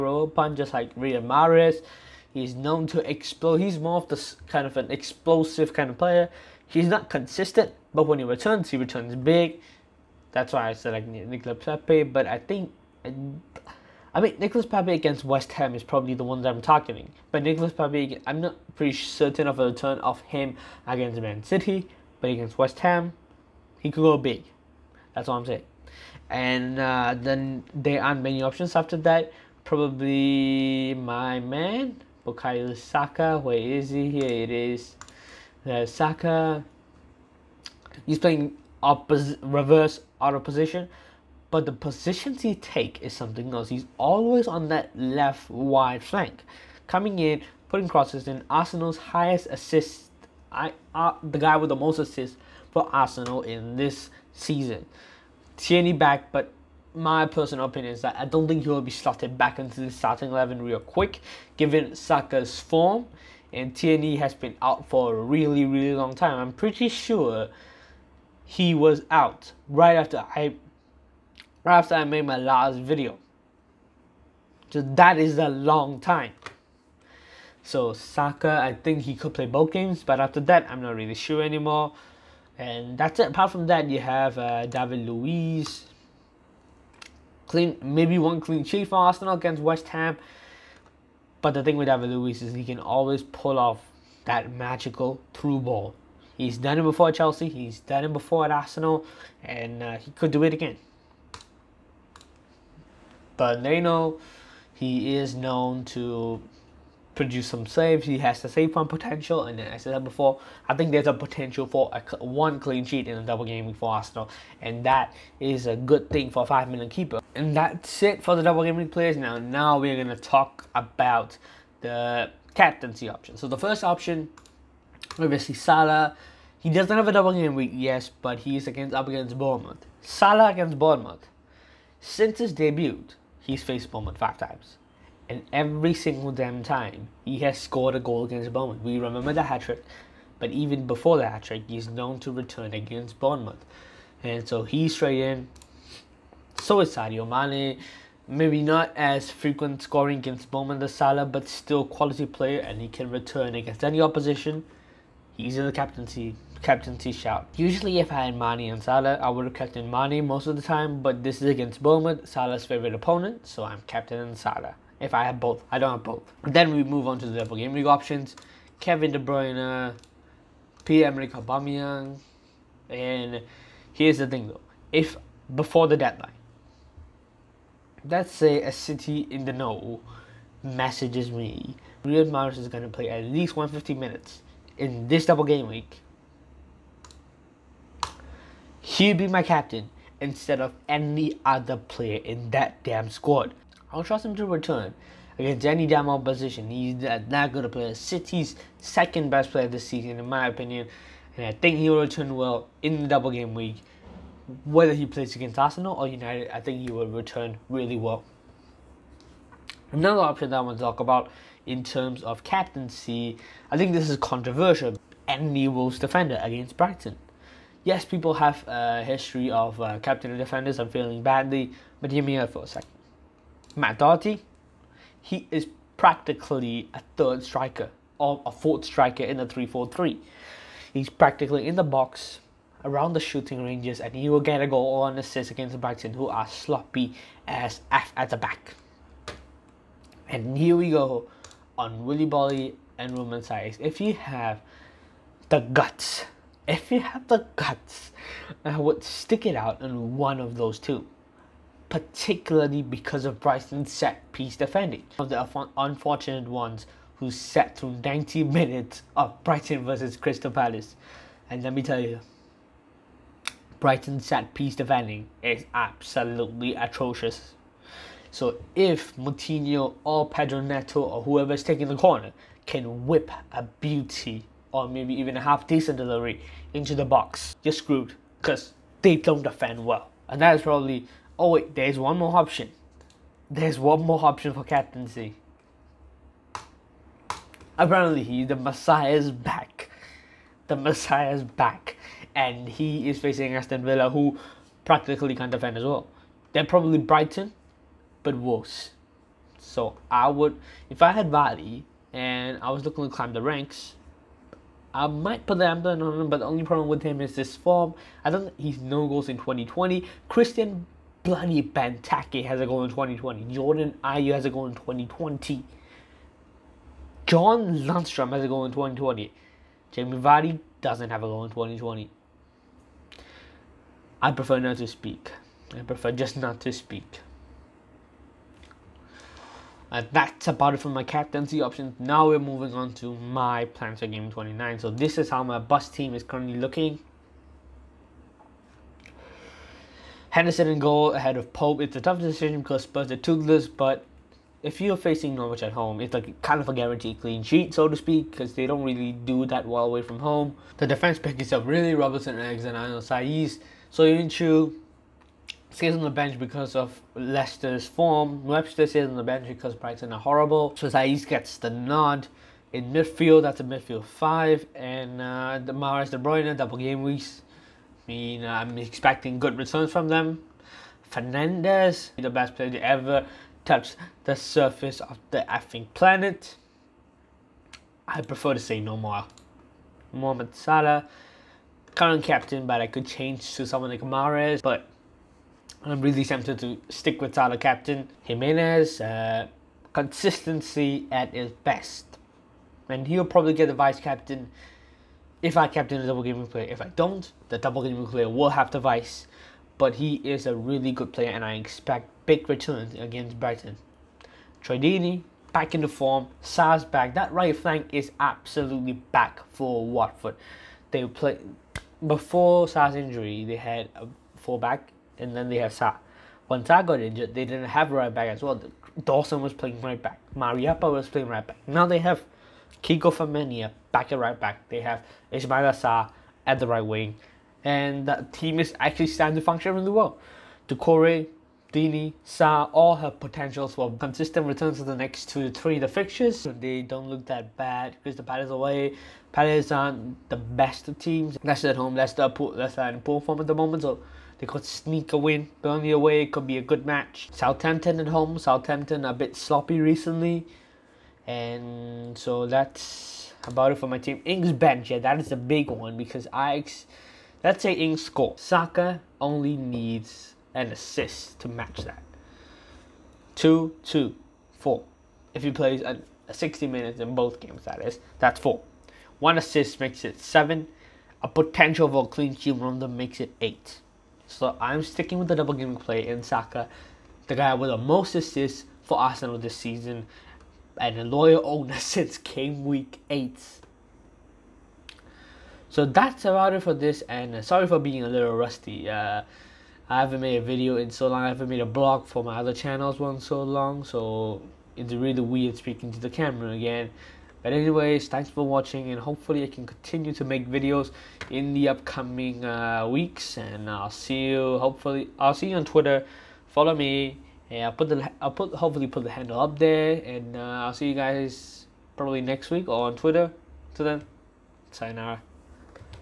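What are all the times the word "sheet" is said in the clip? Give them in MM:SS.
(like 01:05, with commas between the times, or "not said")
01:28, 01:52, 05:47, 07:52.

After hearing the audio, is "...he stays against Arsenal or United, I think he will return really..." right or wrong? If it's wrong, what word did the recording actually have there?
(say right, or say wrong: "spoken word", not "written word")
wrong: "plays", not "stays".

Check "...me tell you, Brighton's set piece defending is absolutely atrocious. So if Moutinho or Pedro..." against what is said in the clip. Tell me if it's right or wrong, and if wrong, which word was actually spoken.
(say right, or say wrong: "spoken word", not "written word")
right.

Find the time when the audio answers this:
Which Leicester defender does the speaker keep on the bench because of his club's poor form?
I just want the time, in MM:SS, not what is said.
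05:41.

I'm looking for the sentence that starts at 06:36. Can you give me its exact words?
If I don't, the double game player will have the vice.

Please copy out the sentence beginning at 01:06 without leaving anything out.
I'm pretty sure he was out right after I after I made my last video.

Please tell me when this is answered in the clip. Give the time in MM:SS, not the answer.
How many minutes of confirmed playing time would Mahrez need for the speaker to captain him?
03:03.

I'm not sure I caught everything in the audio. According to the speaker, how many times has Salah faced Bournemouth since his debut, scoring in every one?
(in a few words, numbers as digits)
5.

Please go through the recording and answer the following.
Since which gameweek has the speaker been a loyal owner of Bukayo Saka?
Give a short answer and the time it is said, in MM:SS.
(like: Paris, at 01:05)
Gameweek 8, at 08:02.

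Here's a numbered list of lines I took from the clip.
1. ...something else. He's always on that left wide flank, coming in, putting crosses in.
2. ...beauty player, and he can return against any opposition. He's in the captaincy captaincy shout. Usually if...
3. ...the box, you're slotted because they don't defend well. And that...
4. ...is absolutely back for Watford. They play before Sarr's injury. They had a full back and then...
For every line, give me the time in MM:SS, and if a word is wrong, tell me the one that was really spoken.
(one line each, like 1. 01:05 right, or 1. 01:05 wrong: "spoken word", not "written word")
1. 00:43 right
2. 02:31 wrong: "quality", not "beauty"
3. 04:36 wrong: "screwed", not "slotted"
4. 06:47 right.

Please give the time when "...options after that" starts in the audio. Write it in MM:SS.
00:28.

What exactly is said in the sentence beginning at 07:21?
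Leicester at home, poor, Leicester the poor form at the moment.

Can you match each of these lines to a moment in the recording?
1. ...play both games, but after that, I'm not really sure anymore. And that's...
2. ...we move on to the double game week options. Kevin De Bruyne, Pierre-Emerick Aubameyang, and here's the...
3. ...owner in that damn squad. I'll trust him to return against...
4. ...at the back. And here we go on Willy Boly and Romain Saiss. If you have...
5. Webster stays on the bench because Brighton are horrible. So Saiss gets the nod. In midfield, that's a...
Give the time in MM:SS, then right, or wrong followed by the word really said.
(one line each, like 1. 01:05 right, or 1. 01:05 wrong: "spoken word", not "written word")
1. 01:19 right
2. 02:46 right
3. 03:11 wrong: "player", not "owner"
4. 03:58 right
5. 05:58 right.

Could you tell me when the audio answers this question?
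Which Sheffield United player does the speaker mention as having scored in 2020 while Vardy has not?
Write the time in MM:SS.
05:17.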